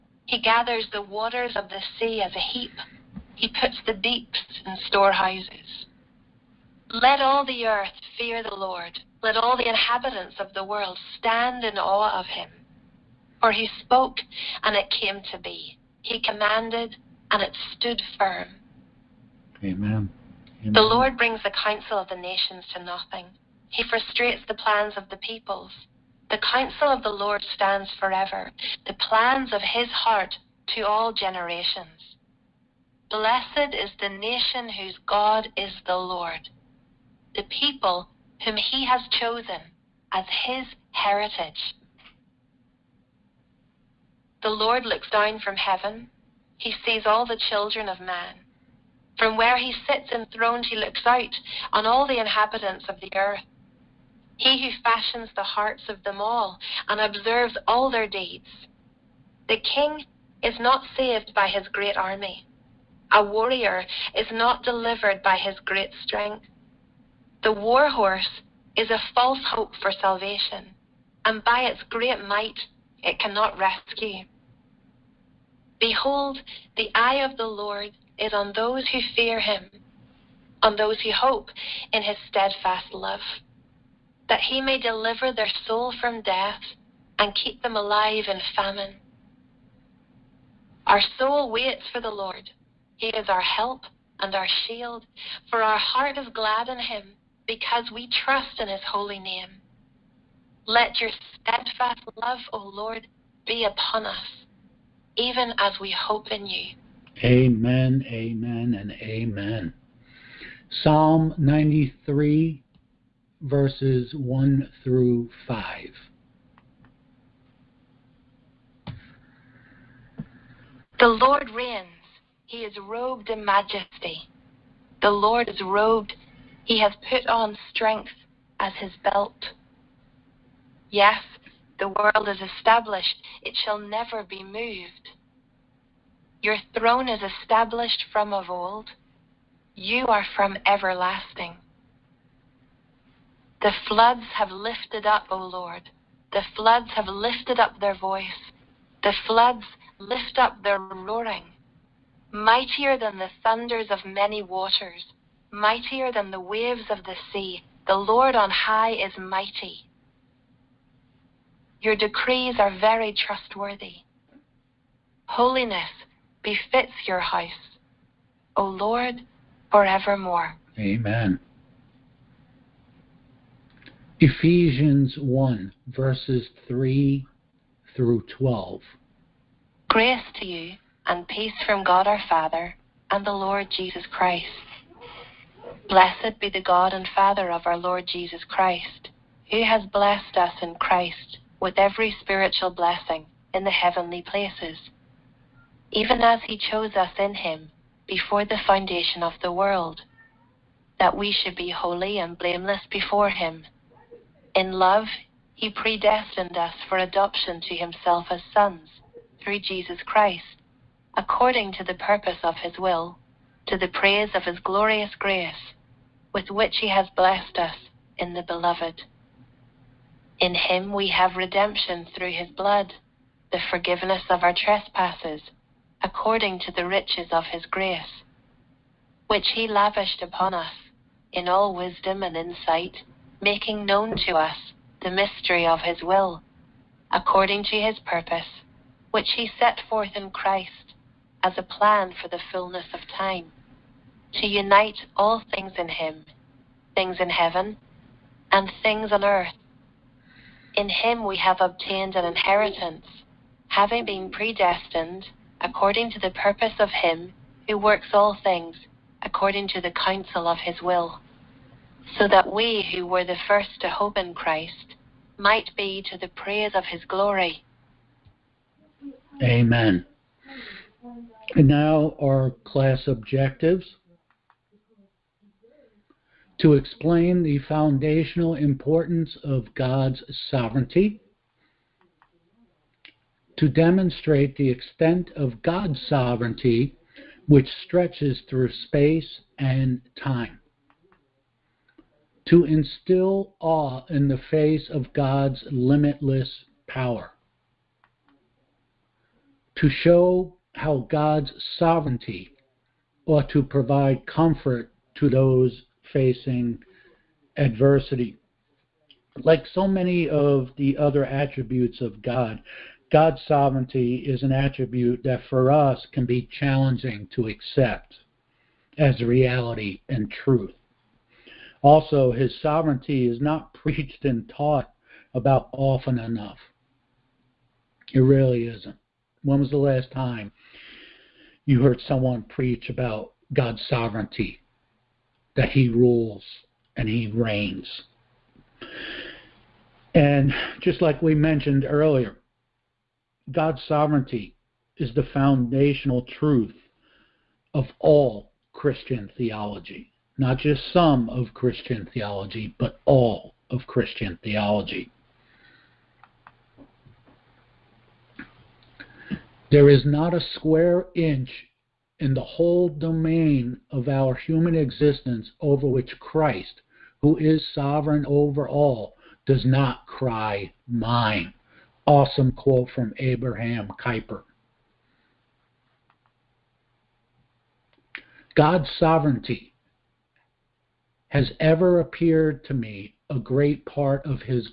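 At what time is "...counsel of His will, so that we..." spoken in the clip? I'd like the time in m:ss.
4:19.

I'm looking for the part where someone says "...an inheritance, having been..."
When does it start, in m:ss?
4:12.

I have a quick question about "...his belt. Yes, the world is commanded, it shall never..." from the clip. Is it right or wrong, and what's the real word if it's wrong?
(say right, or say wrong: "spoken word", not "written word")
wrong: "established", not "commanded".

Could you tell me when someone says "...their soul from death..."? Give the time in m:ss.
1:25.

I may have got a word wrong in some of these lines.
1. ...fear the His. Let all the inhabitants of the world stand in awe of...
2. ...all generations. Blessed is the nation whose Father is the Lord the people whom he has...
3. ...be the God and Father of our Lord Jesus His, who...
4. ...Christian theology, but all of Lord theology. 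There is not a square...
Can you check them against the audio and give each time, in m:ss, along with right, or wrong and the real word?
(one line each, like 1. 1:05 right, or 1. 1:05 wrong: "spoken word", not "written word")
1. 0:08 wrong: "Lord", not "His"
2. 0:30 wrong: "God", not "Father"
3. 3:06 wrong: "Christ", not "His"
4. 5:51 wrong: "Christian", not "Lord".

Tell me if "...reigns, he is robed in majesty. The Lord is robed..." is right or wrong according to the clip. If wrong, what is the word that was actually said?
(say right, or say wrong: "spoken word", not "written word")
right.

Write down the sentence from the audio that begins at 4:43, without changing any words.
To demonstrate the extent of God's sovereignty, which stretches through space and time.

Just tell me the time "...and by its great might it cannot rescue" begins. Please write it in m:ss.
1:11.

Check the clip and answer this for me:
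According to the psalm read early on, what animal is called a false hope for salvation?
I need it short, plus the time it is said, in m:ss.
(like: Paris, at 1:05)
The war horse, at 1:07.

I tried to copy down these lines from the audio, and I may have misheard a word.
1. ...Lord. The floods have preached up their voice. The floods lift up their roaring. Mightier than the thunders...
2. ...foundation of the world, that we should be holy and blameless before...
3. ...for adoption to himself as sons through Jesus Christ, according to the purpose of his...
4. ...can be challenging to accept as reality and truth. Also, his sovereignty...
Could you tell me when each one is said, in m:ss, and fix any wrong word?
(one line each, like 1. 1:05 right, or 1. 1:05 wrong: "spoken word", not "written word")
1. 2:25 wrong: "lifted", not "preached"
2. 3:18 right
3. 3:26 right
4. 5:16 right.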